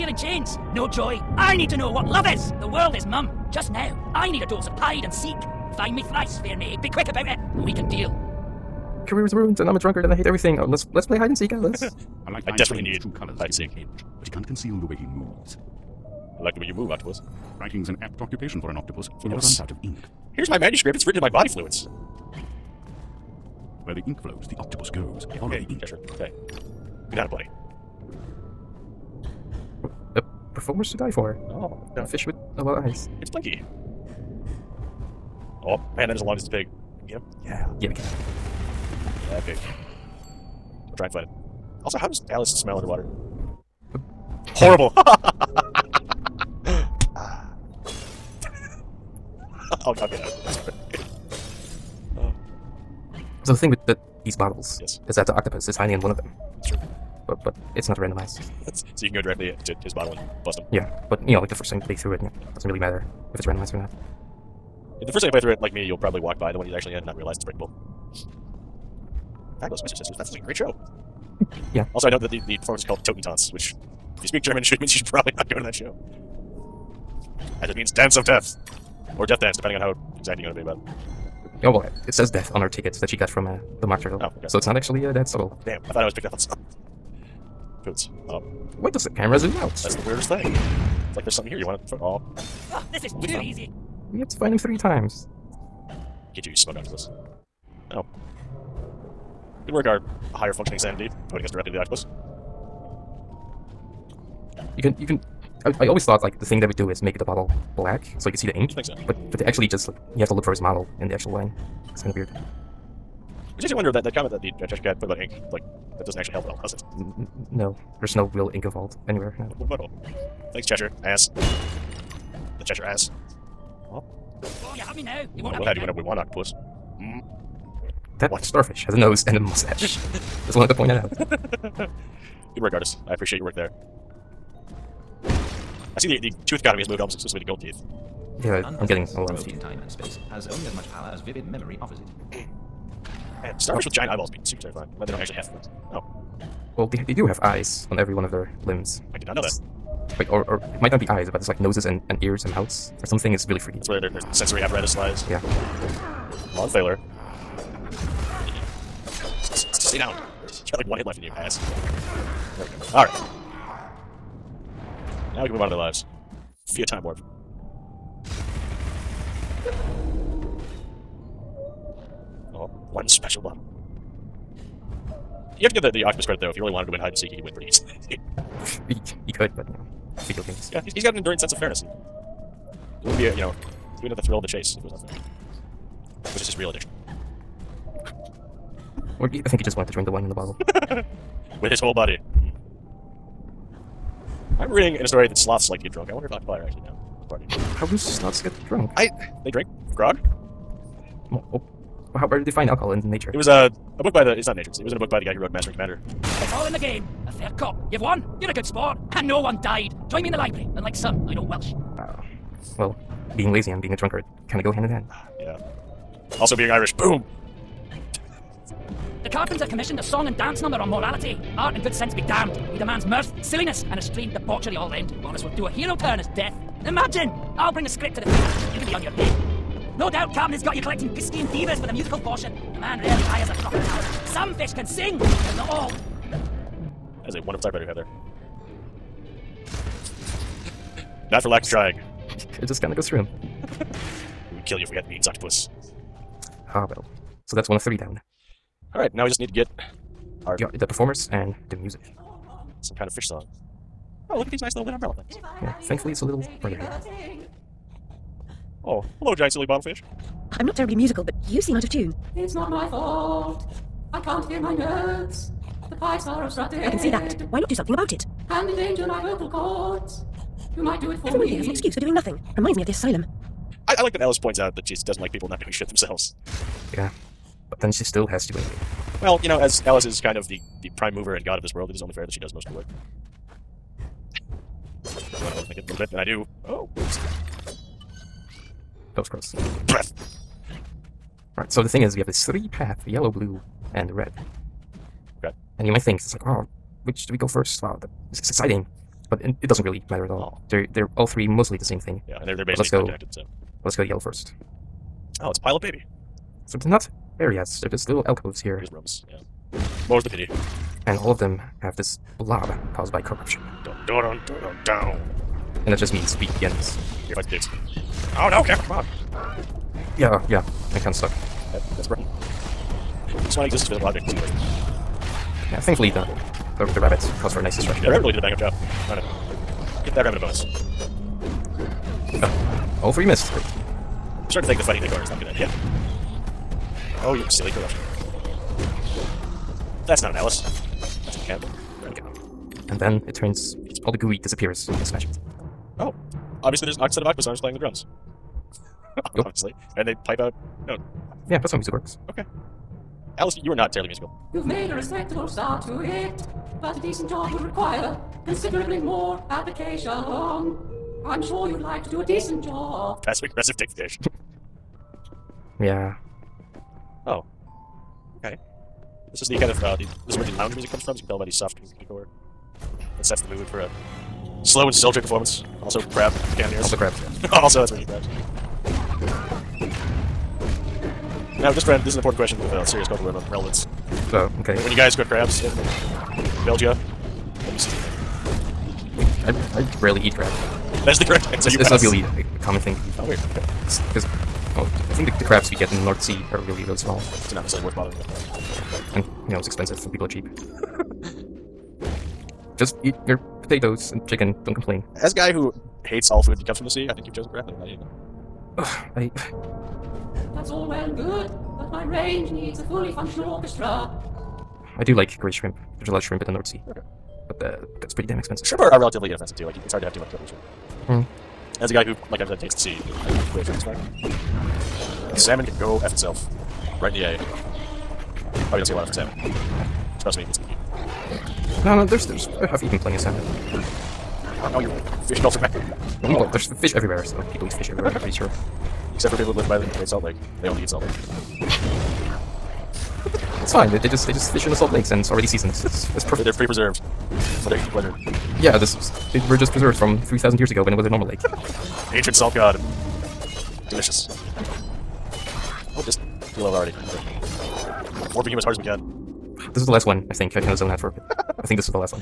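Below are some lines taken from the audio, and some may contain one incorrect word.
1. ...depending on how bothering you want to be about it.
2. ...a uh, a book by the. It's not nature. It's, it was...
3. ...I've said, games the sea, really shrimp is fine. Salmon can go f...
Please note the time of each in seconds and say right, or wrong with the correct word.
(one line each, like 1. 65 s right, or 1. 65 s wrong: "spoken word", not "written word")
1. 79 s wrong: "exacting", not "bothering"
2. 203 s right
3. 422 s wrong: "hates", not "games".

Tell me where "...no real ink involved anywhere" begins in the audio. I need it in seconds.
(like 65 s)
118 s.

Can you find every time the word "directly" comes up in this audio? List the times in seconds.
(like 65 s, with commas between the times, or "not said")
59 s, 101 s.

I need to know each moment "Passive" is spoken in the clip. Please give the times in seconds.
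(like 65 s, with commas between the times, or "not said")
363 s.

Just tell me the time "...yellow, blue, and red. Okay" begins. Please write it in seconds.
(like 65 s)
293 s.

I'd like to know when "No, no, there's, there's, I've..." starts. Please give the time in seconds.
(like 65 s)
431 s.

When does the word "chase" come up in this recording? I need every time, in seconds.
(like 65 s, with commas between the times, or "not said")
184 s.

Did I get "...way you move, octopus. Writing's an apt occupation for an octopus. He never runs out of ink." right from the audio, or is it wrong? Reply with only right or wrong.
right.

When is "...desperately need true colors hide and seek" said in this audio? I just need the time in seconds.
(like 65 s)
12 s.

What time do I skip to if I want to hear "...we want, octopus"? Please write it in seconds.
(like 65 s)
125 s.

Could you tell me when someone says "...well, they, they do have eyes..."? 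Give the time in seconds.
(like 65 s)
146 s.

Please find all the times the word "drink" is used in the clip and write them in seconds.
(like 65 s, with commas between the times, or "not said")
189 s, 199 s.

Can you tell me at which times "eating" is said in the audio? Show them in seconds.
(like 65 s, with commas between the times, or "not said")
407 s, 447 s.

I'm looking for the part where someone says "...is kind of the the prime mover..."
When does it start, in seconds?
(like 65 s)
280 s.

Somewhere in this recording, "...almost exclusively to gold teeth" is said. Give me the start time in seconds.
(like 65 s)
136 s.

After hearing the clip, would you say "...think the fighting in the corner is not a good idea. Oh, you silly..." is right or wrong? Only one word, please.
right.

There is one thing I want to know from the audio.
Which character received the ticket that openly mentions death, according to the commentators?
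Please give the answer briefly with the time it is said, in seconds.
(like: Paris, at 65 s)
the mock turtle, at 83 s.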